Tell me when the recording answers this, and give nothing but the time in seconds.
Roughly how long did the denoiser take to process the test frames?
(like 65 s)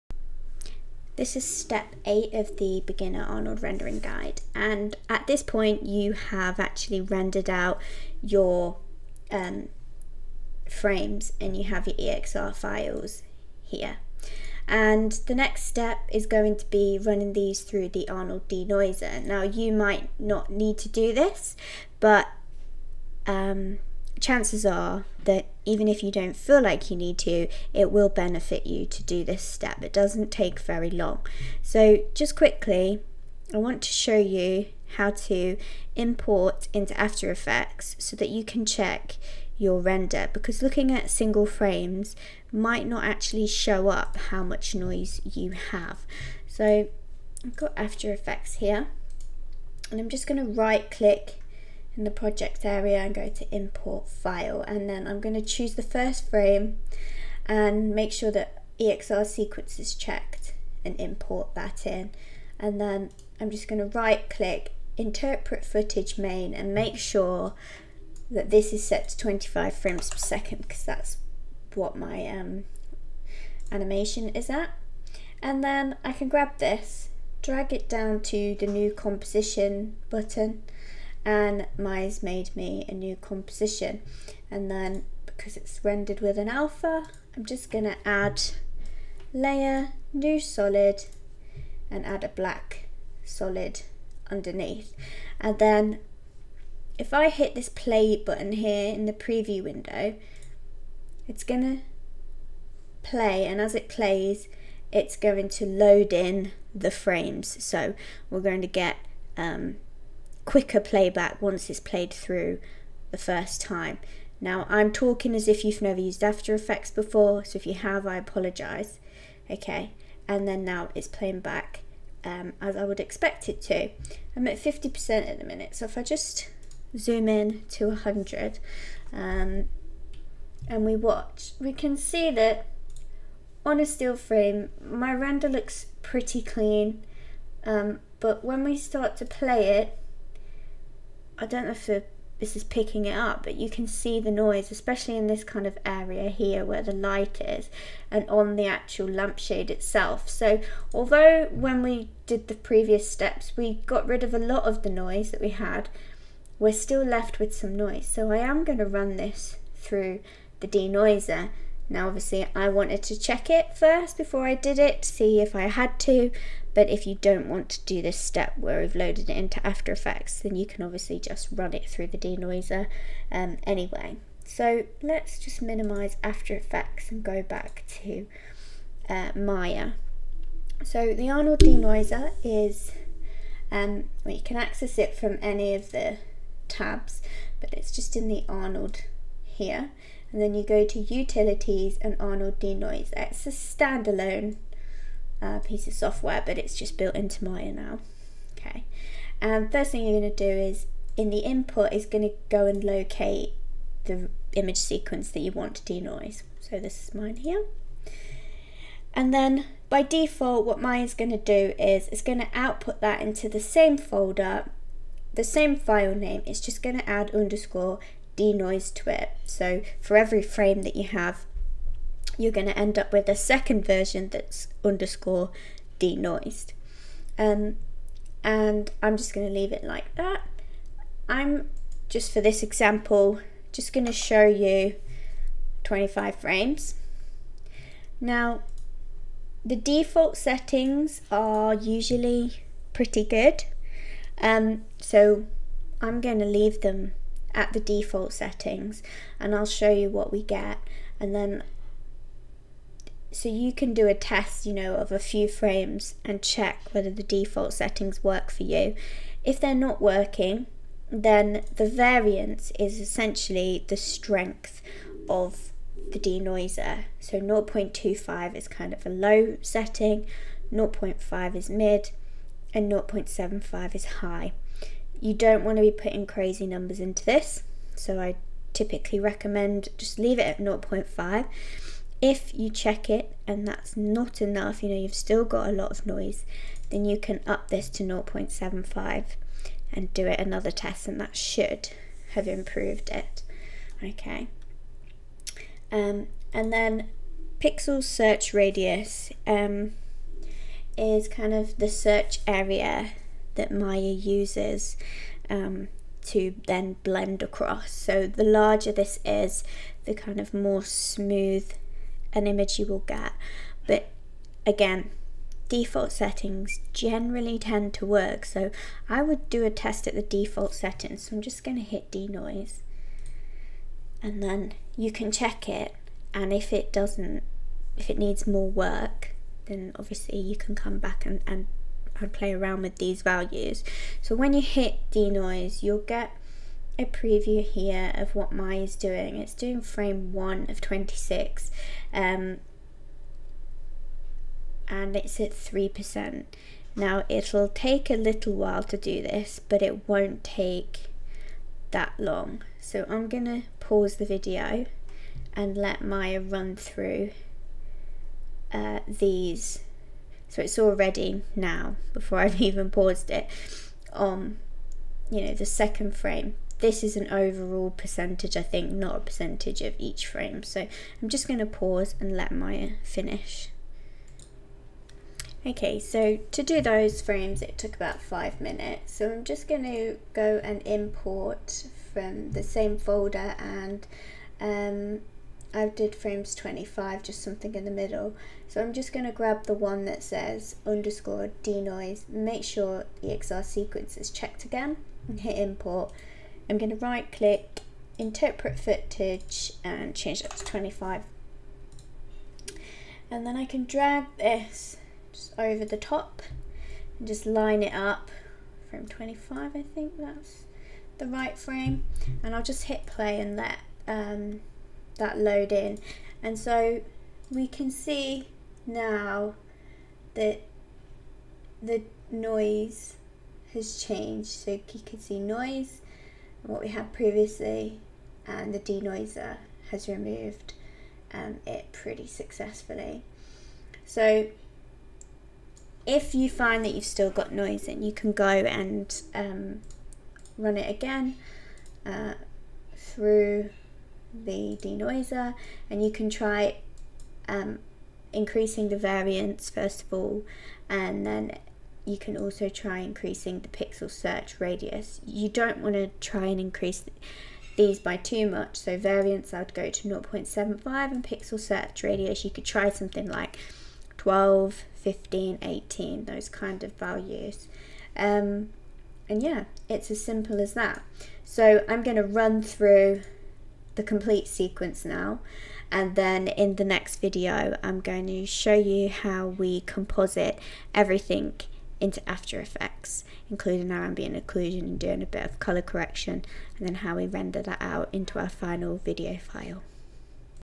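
377 s.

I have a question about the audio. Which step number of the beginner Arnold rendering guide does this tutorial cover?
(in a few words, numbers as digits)
8.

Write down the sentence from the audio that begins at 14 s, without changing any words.
And the next step is going to be running these through the Arnold denoiser.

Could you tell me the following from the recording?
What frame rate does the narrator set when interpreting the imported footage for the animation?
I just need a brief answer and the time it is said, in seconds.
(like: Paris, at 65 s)
25 frames per second, at 69 s.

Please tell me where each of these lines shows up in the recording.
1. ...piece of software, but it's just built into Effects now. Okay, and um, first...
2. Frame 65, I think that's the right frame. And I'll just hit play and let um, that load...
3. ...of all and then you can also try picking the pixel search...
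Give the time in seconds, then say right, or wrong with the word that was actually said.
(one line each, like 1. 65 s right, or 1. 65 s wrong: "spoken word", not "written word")
1. 195 s wrong: "Maya", not "Effects"
2. 408 s wrong: "25", not "65"
3. 450 s wrong: "increasing", not "picking".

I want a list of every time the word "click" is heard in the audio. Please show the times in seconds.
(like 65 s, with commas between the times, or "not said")
50 s, 64 s, 397 s.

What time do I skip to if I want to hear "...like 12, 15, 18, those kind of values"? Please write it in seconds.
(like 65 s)
463 s.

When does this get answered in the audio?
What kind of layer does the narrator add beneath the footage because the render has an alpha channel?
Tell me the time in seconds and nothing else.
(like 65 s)
92 s.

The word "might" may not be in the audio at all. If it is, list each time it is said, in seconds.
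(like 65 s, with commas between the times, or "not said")
19 s, 42 s.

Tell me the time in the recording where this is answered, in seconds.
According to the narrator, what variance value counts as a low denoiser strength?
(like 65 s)
267 s.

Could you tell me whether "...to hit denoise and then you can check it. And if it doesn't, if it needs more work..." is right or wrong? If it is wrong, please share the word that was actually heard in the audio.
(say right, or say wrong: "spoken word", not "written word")
right.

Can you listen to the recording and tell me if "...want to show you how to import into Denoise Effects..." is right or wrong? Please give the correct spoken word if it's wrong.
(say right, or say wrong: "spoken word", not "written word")
wrong: "After", not "Denoise".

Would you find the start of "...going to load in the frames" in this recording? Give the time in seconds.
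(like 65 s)
105 s.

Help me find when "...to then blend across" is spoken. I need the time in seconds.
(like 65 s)
306 s.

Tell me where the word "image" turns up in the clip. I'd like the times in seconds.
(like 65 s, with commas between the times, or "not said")
204 s, 312 s.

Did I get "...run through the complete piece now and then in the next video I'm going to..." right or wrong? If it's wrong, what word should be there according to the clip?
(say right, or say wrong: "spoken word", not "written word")
wrong: "sequence", not "piece".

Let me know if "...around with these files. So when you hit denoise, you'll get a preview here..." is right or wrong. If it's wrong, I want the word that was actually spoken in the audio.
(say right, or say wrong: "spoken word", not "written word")
wrong: "values", not "files".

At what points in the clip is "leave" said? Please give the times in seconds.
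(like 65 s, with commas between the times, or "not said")
229 s, 246 s, 280 s.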